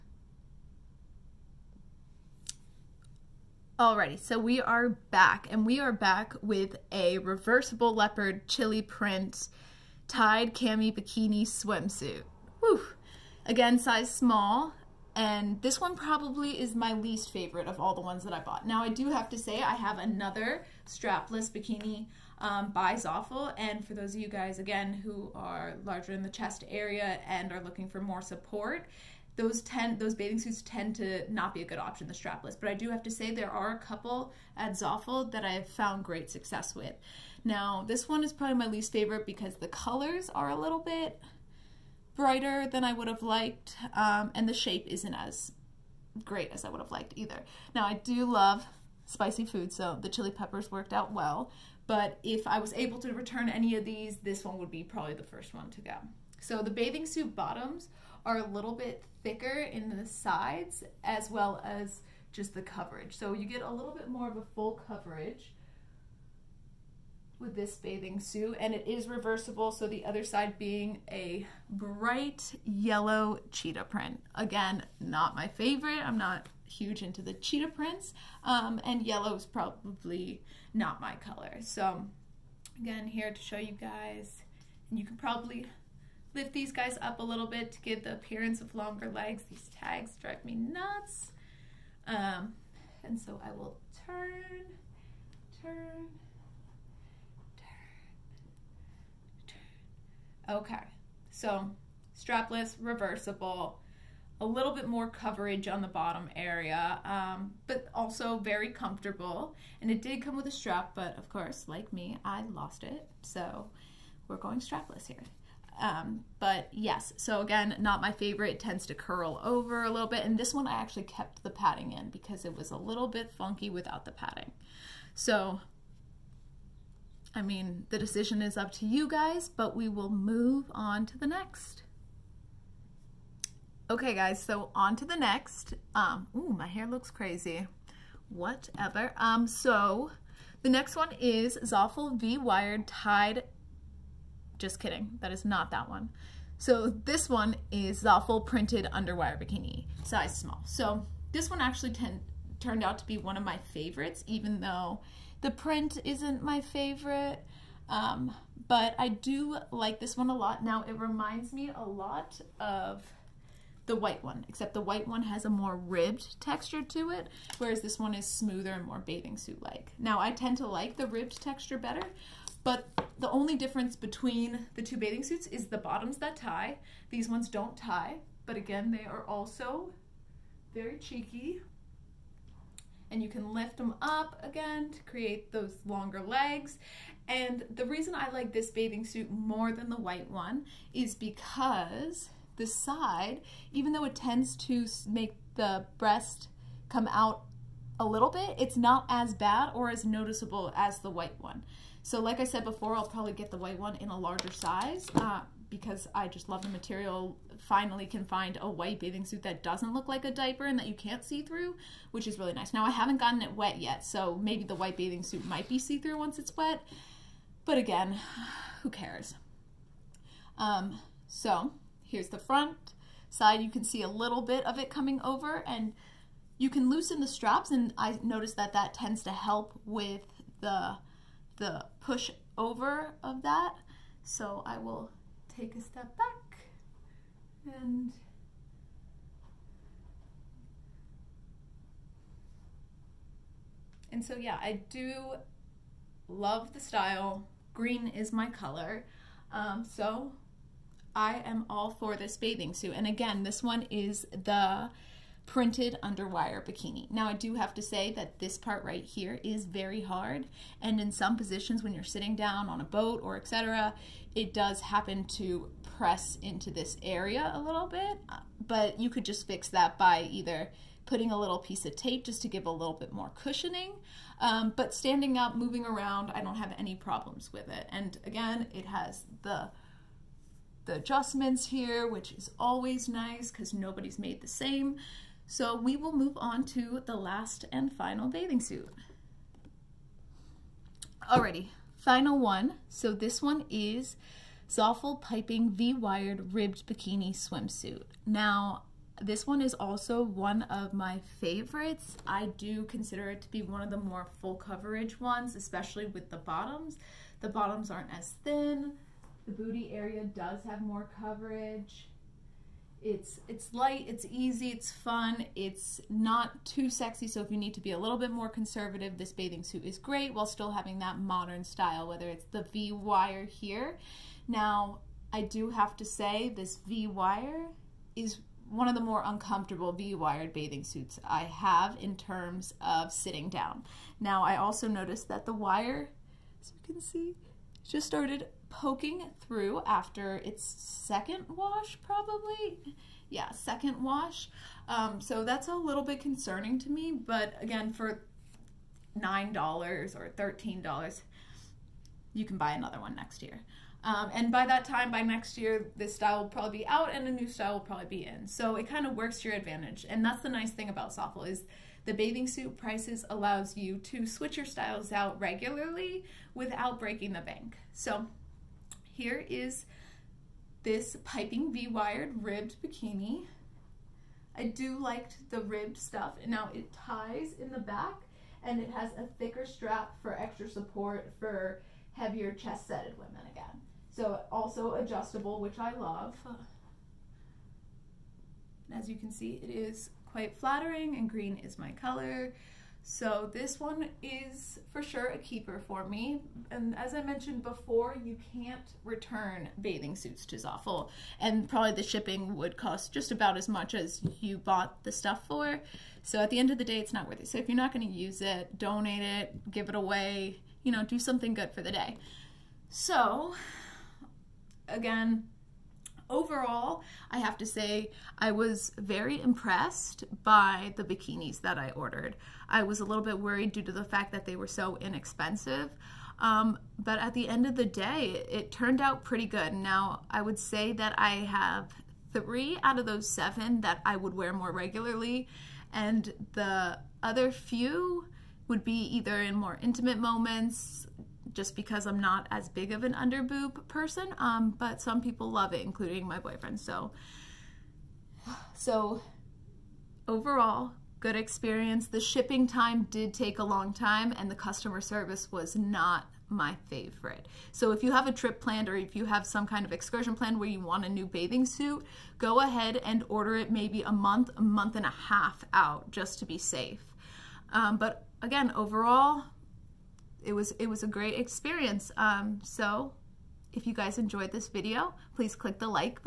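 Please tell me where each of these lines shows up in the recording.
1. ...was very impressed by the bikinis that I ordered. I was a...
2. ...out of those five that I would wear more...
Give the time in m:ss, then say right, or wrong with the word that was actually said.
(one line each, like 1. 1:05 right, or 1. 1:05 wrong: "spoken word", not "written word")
1. 6:58 right
2. 7:12 wrong: "seven", not "five".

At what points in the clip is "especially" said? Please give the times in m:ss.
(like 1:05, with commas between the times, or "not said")
5:05.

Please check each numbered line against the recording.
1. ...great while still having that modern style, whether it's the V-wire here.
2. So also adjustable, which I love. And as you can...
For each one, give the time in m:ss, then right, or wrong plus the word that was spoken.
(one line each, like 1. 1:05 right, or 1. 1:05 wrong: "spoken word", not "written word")
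1. 5:19 right
2. 6:24 right.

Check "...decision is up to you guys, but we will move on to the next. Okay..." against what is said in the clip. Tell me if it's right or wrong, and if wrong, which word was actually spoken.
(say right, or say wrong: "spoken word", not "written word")
right.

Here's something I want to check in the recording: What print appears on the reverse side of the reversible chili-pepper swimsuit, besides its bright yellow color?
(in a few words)
Cheetah print.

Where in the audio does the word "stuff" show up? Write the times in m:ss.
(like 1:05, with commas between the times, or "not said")
6:15, 6:45.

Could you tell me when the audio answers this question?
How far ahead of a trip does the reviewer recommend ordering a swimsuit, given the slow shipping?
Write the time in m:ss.
7:44.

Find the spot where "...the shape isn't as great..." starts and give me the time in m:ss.
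0:44.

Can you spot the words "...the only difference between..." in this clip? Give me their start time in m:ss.
2:53.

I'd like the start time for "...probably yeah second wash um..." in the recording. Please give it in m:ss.
5:42.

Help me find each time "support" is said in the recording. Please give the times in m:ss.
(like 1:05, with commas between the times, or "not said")
0:28, 6:20.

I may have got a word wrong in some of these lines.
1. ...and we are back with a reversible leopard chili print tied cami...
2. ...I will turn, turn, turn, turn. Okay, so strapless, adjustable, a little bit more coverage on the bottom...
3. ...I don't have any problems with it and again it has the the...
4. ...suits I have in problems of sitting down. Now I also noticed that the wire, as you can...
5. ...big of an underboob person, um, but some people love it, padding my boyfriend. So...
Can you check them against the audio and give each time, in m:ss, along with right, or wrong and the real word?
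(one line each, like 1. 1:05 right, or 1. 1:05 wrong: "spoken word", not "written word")
1. 0:05 right
2. 1:33 wrong: "reversible", not "adjustable"
3. 4:36 right
4. 5:30 wrong: "terms", not "problems"
5. 7:22 wrong: "including", not "padding".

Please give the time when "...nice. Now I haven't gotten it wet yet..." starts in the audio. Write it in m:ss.
3:32.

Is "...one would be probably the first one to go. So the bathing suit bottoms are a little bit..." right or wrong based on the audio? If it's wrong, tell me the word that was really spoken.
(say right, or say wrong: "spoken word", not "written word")
right.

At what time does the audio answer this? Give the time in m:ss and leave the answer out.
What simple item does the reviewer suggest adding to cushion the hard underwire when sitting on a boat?
4:31.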